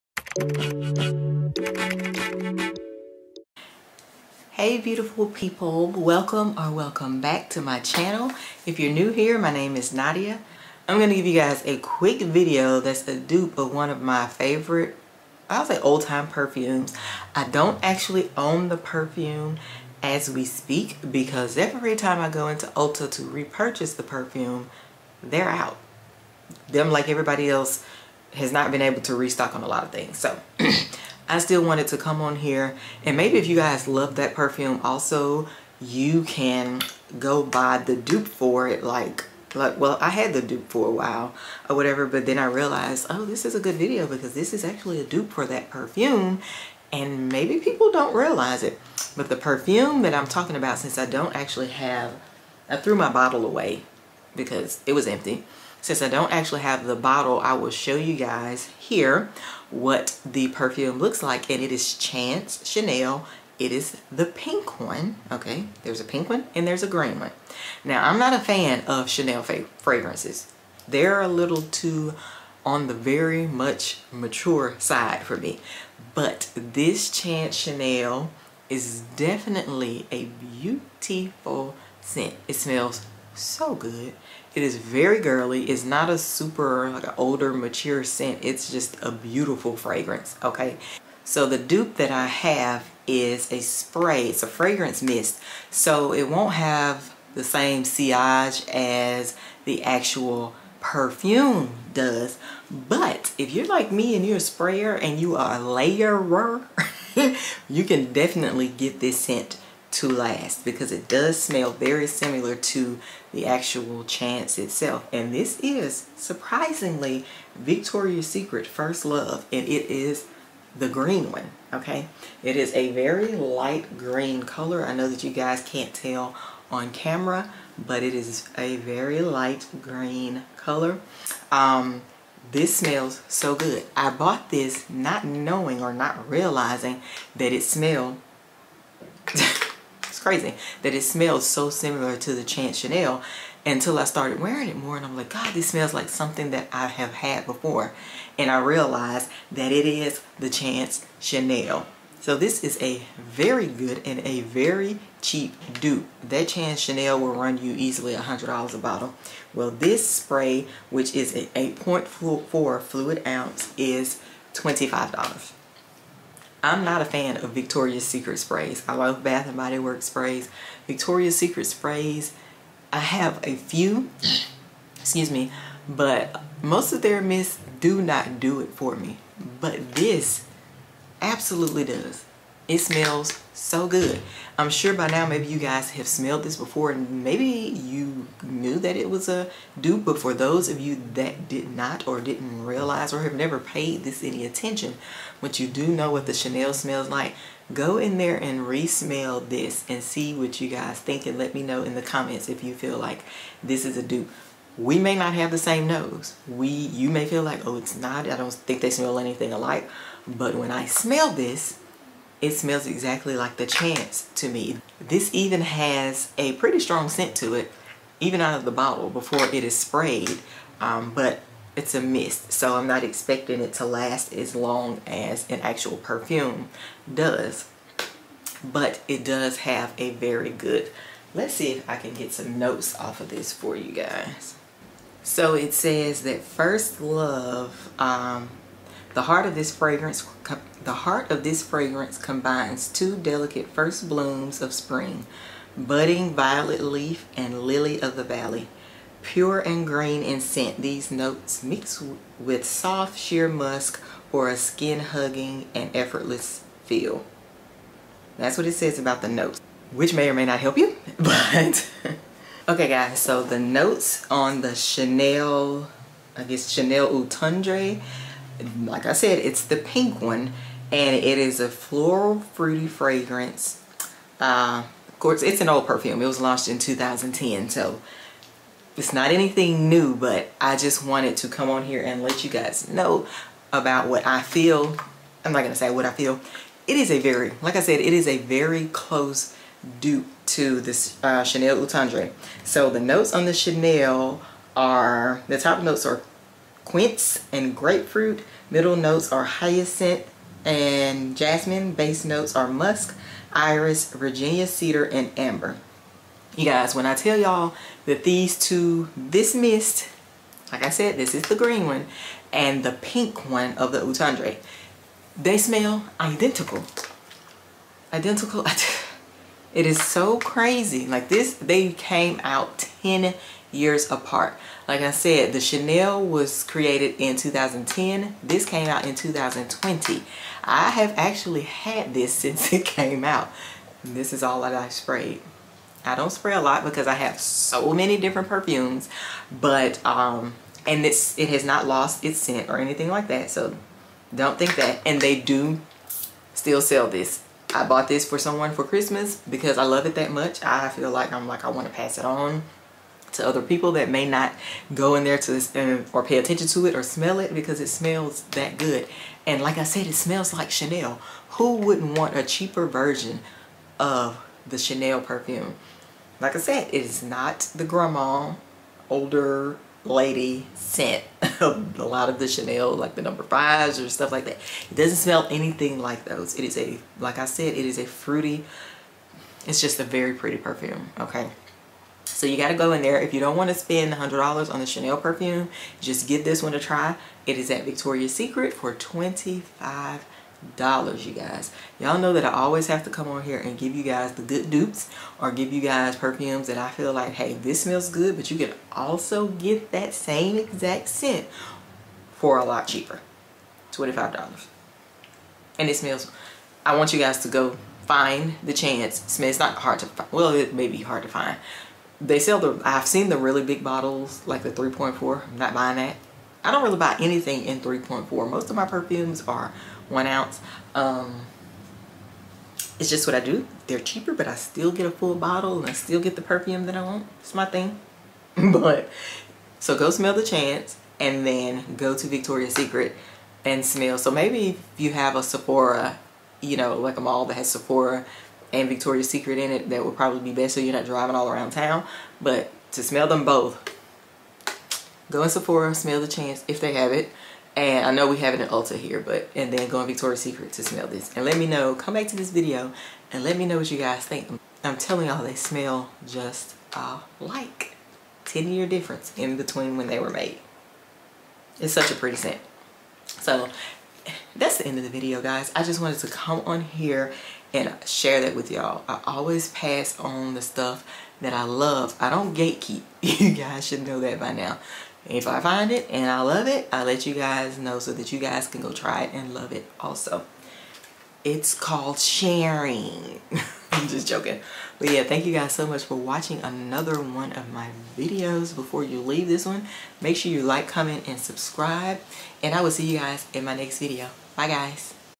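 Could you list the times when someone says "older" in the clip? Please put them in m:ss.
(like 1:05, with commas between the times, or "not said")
1:27, 6:09.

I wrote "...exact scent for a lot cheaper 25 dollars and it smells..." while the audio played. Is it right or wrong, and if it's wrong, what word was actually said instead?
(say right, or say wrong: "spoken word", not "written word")
right.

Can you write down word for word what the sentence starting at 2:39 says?
Well, this spray, which is a 8.4 fluid ounce, is $25.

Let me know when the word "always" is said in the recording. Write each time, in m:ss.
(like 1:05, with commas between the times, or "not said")
6:32, 7:49.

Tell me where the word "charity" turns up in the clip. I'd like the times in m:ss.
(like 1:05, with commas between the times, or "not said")
not said.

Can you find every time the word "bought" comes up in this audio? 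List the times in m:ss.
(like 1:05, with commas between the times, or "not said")
2:14, 5:47.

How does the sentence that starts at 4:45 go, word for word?
I'm not going to say what I feel.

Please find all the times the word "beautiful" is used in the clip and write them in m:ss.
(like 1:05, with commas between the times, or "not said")
0:04, 1:20, 1:29.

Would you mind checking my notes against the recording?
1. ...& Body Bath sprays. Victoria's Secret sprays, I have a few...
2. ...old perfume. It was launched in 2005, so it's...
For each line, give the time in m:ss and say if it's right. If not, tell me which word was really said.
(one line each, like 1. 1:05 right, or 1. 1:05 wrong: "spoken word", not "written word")
1. 2:49 wrong: "Works", not "Bath"
2. 4:35 wrong: "2010", not "2005".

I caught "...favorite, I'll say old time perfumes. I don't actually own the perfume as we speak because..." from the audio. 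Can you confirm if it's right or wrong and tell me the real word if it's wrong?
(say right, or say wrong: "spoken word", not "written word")
right.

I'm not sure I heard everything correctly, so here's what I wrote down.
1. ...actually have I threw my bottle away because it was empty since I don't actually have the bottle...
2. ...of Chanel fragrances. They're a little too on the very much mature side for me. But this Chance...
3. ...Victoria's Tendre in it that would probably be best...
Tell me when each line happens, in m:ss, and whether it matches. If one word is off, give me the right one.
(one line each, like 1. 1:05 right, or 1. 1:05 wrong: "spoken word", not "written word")
1. 0:51 right
2. 1:08 right
3. 7:18 wrong: "Secret", not "Tendre".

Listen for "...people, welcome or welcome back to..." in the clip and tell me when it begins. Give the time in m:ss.
0:05.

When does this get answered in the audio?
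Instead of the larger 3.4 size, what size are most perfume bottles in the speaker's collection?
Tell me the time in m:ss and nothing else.
7:00.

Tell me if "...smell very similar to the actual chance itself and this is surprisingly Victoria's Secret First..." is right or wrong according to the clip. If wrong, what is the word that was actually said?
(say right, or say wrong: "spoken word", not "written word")
right.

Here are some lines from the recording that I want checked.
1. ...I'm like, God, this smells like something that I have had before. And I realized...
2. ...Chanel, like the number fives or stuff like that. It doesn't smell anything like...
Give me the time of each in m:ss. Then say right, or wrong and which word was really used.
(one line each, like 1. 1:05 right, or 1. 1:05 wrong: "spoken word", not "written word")
1. 2:25 right
2. 6:12 right.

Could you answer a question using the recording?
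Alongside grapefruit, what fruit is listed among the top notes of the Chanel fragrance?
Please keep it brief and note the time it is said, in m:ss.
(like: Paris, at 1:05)
quince, at 4:56.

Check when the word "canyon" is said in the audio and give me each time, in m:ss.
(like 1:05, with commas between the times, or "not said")
not said.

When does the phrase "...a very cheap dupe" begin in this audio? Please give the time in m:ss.
2:34.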